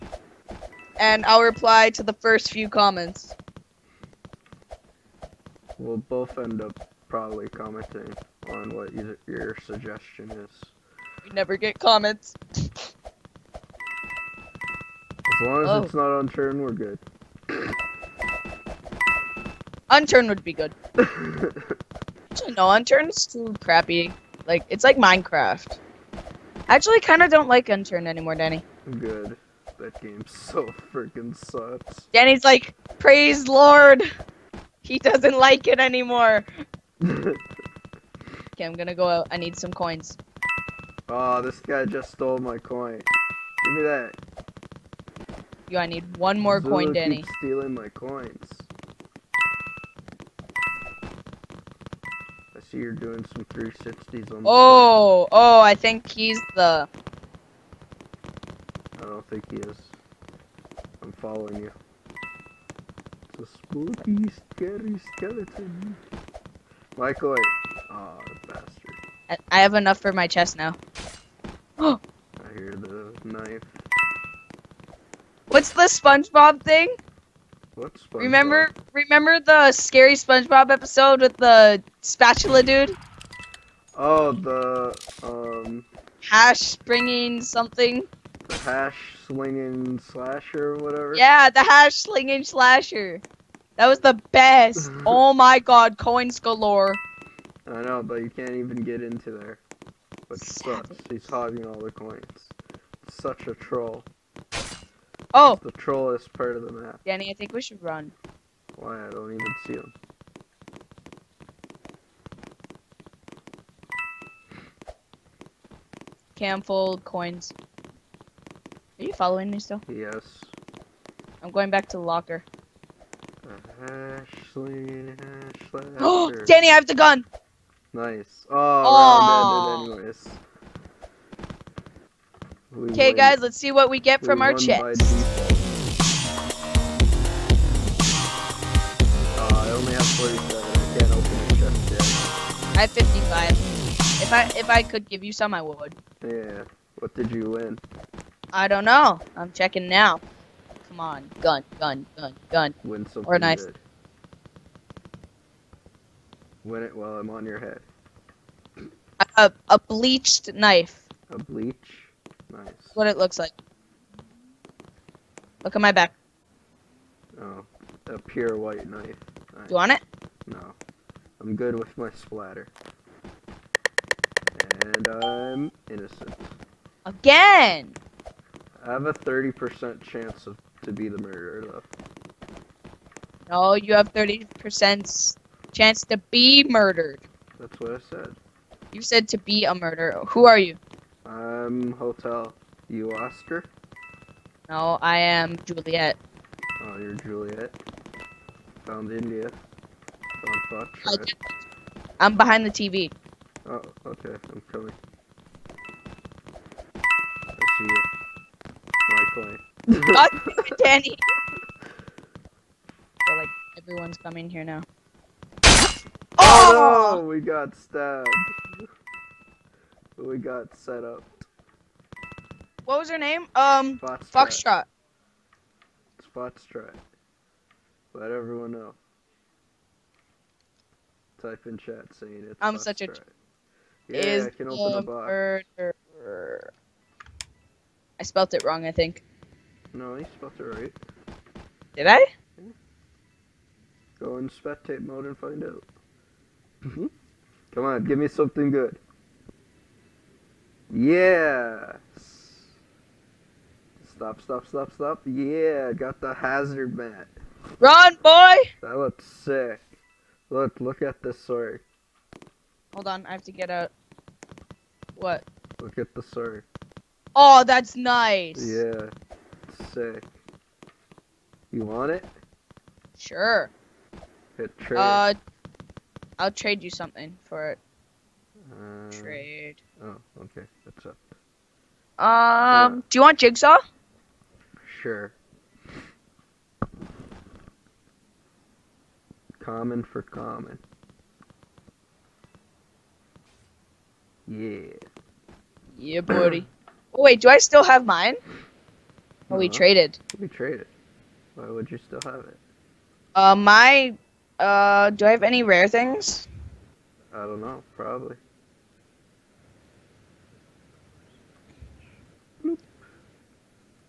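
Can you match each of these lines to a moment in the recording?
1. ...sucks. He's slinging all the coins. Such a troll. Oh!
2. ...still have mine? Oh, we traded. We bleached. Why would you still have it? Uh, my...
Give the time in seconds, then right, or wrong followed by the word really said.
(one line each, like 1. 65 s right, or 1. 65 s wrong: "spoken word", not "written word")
1. 100 s wrong: "hogging", not "slinging"
2. 297 s wrong: "traded", not "bleached".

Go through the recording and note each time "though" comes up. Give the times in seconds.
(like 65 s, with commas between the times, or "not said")
181 s.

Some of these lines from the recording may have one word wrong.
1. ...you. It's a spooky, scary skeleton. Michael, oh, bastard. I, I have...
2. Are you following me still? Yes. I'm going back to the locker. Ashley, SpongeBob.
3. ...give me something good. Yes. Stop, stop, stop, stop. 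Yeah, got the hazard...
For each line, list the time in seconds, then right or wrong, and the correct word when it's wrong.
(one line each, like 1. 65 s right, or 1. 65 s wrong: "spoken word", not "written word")
1. 61 s right
2. 118 s wrong: "Ashley", not "SpongeBob"
3. 248 s right.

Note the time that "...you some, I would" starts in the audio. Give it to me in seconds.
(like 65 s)
145 s.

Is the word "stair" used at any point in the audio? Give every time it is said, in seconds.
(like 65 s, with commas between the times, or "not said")
not said.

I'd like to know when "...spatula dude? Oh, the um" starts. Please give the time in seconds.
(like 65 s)
82 s.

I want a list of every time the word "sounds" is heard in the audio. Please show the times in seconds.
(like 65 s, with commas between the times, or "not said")
not said.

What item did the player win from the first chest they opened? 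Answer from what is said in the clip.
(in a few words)
A bleached knife.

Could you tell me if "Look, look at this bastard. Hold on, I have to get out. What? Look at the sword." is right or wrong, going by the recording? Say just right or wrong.
wrong.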